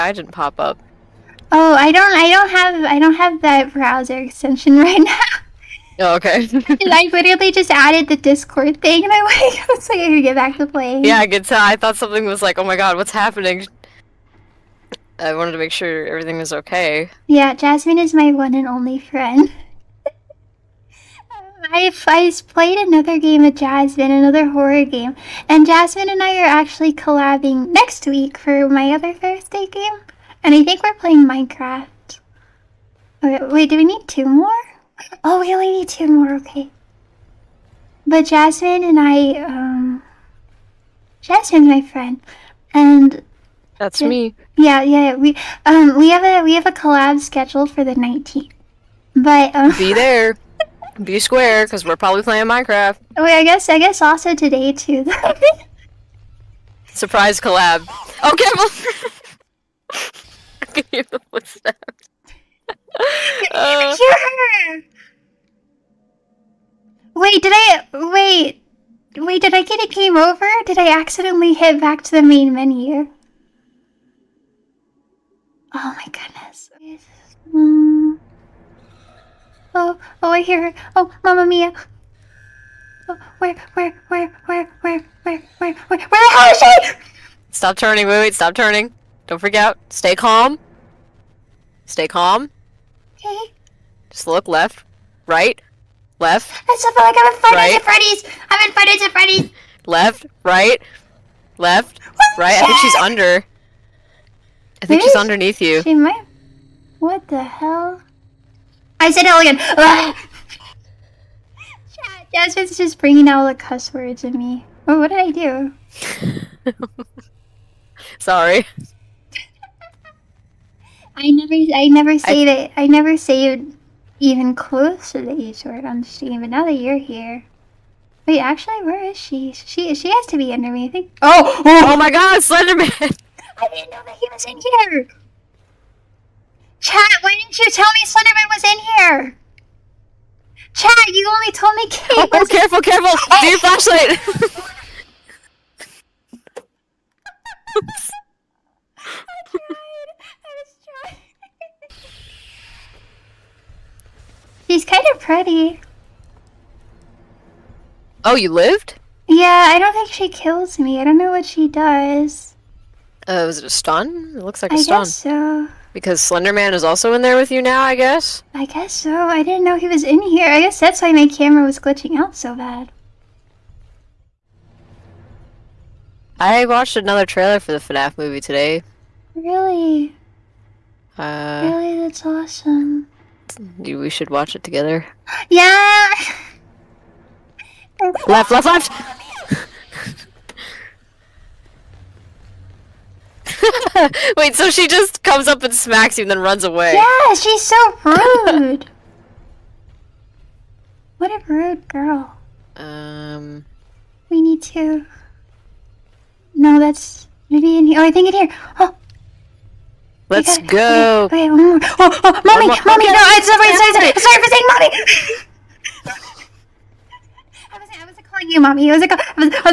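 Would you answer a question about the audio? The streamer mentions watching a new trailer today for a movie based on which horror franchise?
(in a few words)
FNAF.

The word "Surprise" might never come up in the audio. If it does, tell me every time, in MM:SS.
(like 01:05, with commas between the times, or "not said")
00:56.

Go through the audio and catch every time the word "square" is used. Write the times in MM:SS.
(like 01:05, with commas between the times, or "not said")
00:51.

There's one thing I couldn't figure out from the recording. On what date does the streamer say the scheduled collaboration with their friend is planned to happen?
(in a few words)
the 19th.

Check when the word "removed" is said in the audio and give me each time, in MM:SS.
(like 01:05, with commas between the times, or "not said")
not said.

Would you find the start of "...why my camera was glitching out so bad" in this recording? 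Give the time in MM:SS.
02:51.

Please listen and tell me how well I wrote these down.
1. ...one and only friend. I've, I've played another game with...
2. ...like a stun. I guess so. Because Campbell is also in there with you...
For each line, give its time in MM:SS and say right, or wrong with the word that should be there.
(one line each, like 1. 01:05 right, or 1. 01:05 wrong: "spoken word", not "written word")
1. 00:18 right
2. 02:44 wrong: "Slenderman", not "Campbell".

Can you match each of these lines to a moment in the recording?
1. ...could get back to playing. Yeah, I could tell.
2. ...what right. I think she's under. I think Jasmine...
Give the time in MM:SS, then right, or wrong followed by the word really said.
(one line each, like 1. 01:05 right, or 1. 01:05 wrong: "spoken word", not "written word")
1. 00:10 right
2. 01:42 wrong: "Maybe", not "Jasmine".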